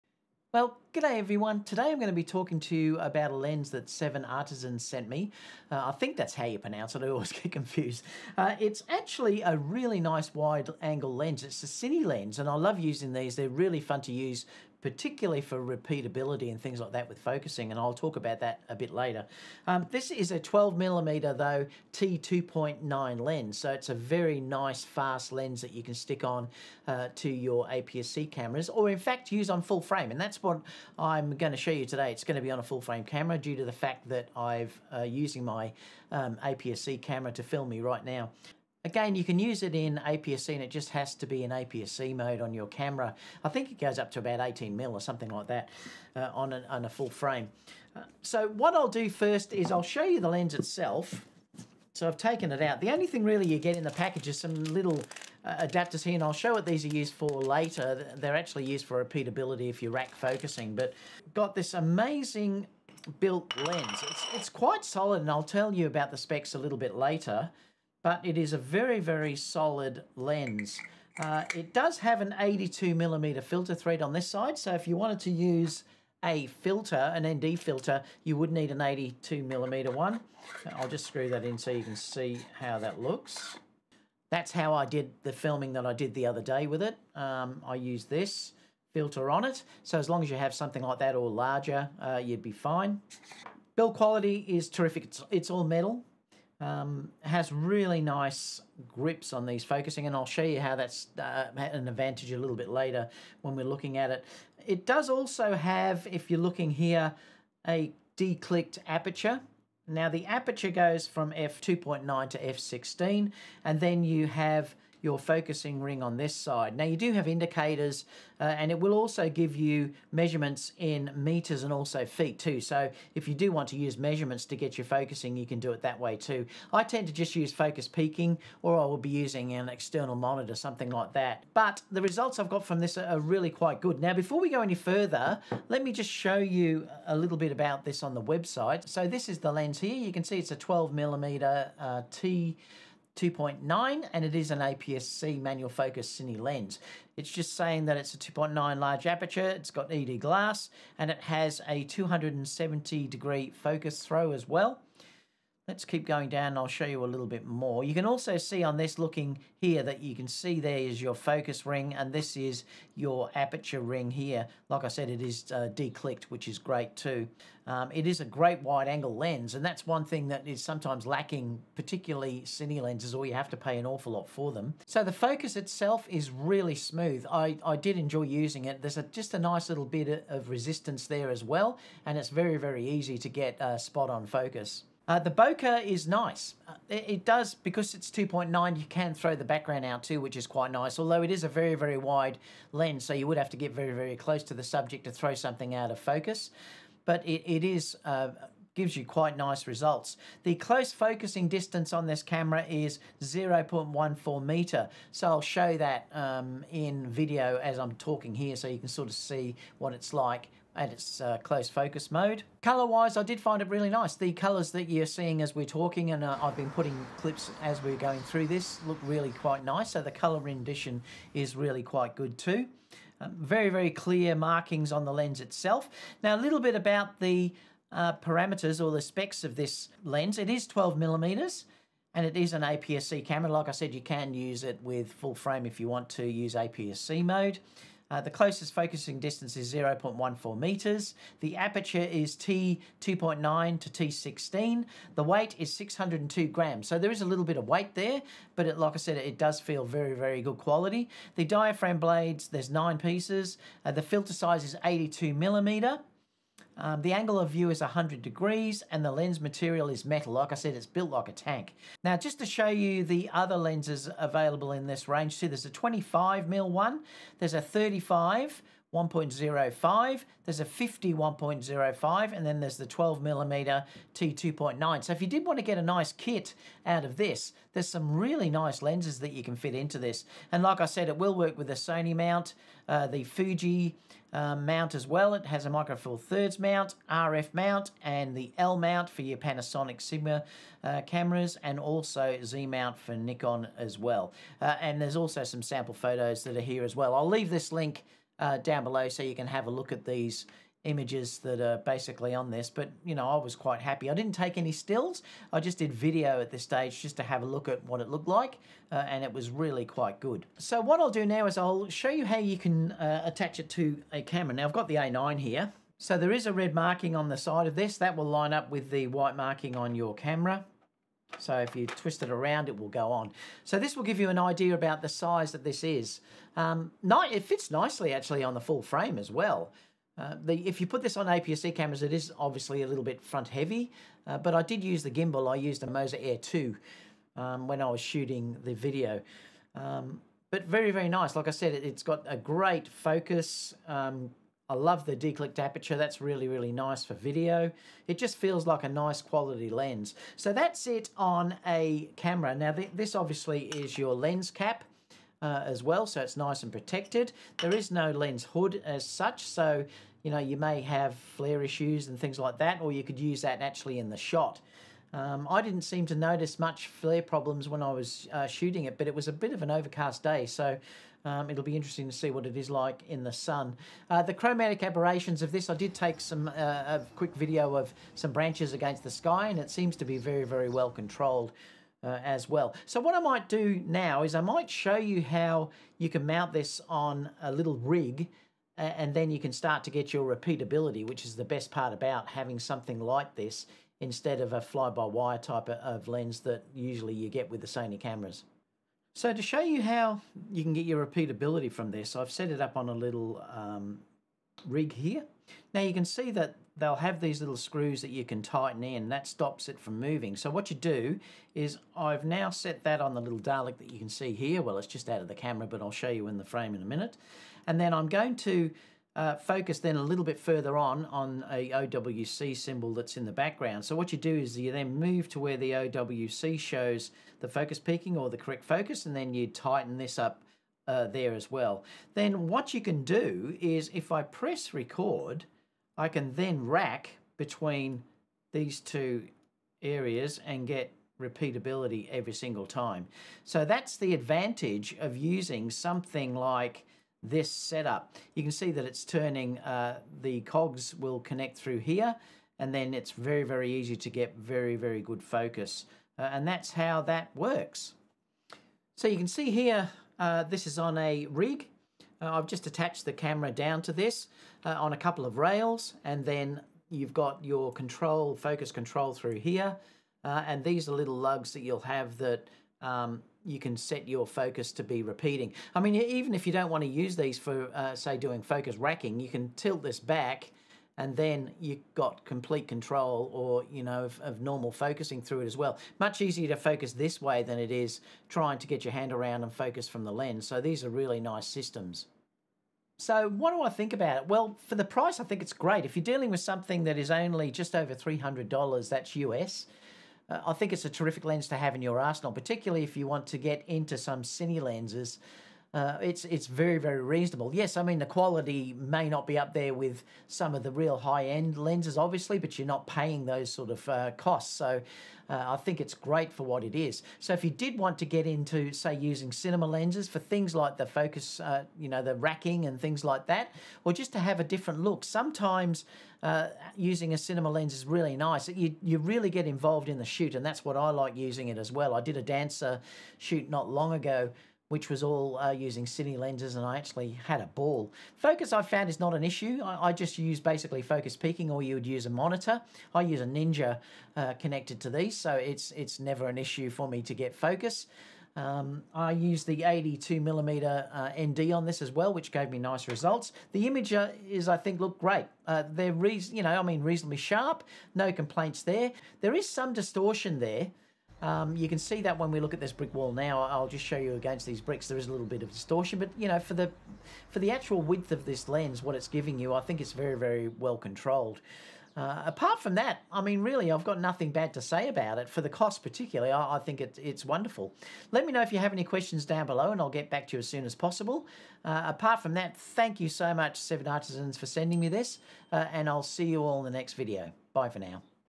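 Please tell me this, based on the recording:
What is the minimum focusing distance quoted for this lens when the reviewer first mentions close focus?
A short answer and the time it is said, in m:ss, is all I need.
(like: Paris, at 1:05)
0.14 meter, at 3:23.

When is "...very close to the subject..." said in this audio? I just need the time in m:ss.
3:13.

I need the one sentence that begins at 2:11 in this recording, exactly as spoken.
But the results I've got from this are really quite good.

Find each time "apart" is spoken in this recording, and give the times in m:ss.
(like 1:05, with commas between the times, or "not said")
9:32, 9:41.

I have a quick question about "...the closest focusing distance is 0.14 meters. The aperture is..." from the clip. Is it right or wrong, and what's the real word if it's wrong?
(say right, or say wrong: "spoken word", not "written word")
right.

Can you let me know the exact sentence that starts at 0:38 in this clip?
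Again, you can use it in APS-C and it just has to be in APS-C mode on your camera.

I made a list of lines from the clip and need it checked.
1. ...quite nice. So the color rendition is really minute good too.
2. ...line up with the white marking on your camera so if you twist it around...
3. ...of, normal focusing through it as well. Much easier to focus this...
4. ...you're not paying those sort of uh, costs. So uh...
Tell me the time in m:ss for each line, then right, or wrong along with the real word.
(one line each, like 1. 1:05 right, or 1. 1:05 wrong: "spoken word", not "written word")
1. 3:39 wrong: "quite", not "minute"
2. 5:18 right
3. 8:04 right
4. 8:32 right.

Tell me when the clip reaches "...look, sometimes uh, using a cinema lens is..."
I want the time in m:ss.
8:44.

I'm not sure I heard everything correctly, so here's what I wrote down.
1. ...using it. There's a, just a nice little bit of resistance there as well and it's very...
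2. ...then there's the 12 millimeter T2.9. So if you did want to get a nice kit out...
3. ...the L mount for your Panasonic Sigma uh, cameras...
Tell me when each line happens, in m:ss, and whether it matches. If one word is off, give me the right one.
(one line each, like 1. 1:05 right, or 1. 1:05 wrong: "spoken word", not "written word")
1. 2:58 right
2. 4:32 right
3. 4:48 right.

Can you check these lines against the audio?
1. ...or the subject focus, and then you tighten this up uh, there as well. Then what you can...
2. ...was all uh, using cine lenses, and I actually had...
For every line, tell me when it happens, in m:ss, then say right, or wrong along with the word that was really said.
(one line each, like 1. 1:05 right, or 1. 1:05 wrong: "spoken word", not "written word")
1. 7:08 wrong: "correct", not "subject"
2. 8:54 right.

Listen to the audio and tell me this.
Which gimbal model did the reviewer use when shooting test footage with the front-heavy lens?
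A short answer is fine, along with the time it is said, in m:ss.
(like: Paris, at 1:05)
Moza Air 2, at 5:35.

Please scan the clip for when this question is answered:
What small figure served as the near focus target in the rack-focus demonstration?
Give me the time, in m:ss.
6:53.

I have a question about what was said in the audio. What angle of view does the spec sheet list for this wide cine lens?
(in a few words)
100 degrees.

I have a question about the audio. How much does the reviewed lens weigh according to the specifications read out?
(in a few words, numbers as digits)
602 grams.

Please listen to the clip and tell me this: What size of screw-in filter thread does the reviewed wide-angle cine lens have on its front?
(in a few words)
82mm.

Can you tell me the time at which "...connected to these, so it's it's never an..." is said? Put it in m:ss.
9:04.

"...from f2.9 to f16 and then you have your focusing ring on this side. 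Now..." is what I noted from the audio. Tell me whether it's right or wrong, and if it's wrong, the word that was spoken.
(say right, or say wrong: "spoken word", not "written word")
right.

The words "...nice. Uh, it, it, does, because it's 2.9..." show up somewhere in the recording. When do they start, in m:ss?
3:06.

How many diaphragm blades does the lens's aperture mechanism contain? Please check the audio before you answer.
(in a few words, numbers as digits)
nine.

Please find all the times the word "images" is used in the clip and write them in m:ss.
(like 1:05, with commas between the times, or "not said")
5:00, 9:13.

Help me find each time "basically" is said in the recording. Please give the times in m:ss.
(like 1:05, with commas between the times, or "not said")
5:01, 9:00.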